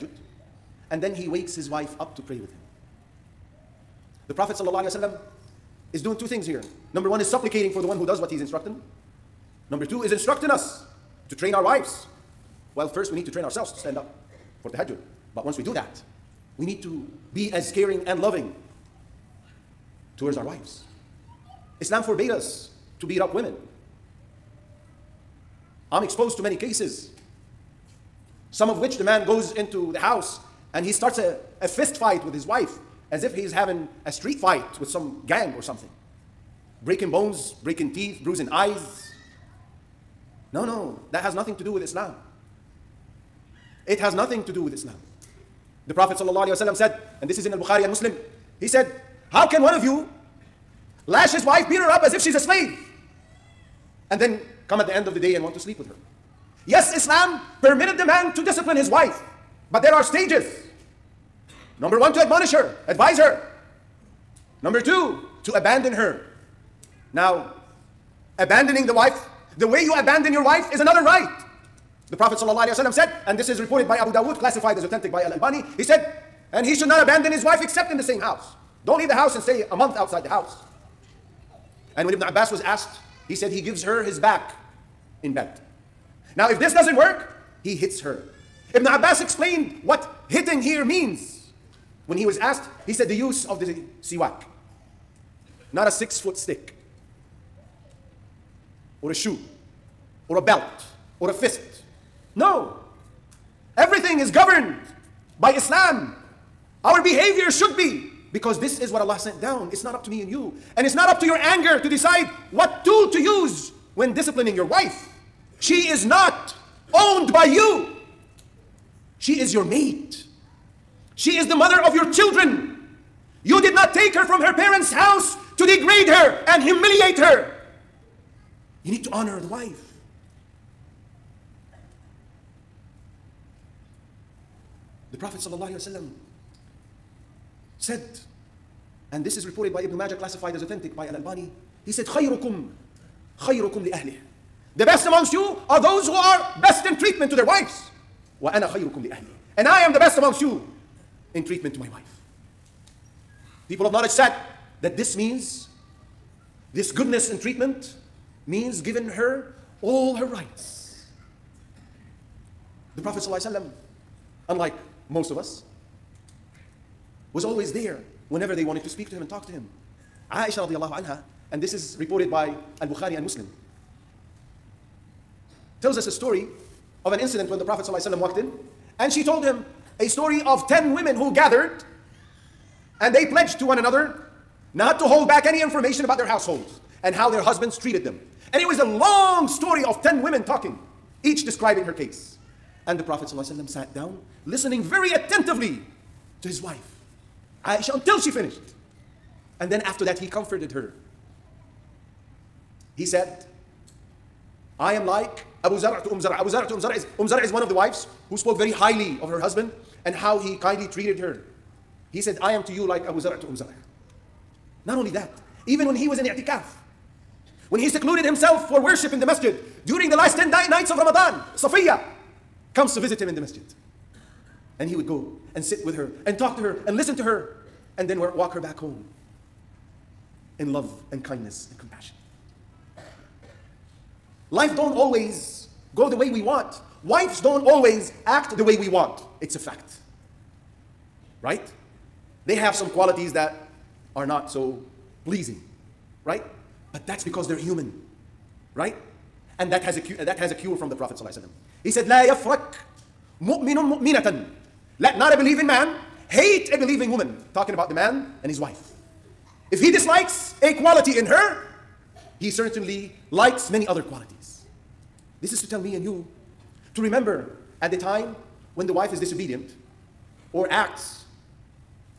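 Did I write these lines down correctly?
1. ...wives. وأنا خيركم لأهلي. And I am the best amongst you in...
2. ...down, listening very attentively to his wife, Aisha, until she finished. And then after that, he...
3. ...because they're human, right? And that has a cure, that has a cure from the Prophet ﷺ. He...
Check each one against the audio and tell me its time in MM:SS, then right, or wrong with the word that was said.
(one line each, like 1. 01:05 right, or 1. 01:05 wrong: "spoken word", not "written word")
1. 02:27 right
2. 03:13 right
3. 04:07 right.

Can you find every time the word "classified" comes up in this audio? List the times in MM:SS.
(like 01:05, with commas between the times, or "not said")
01:14, 02:20.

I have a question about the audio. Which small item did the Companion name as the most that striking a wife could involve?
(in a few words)
siwak.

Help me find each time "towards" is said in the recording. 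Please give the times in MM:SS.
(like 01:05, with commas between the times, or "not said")
00:20.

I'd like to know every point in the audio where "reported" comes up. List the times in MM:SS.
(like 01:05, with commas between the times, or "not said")
01:13, 02:19, 02:51.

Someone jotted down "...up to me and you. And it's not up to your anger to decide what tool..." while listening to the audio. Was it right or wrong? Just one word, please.
right.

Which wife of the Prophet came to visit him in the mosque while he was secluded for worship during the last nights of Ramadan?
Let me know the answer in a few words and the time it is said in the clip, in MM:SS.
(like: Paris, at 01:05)
Safiya, at 03:41.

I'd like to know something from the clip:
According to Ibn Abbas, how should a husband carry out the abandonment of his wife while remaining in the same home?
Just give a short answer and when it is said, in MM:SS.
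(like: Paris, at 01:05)
gives her his back in bed, at 01:23.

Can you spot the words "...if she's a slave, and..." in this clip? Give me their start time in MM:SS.
00:52.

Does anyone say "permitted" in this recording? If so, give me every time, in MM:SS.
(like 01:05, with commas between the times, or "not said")
00:57.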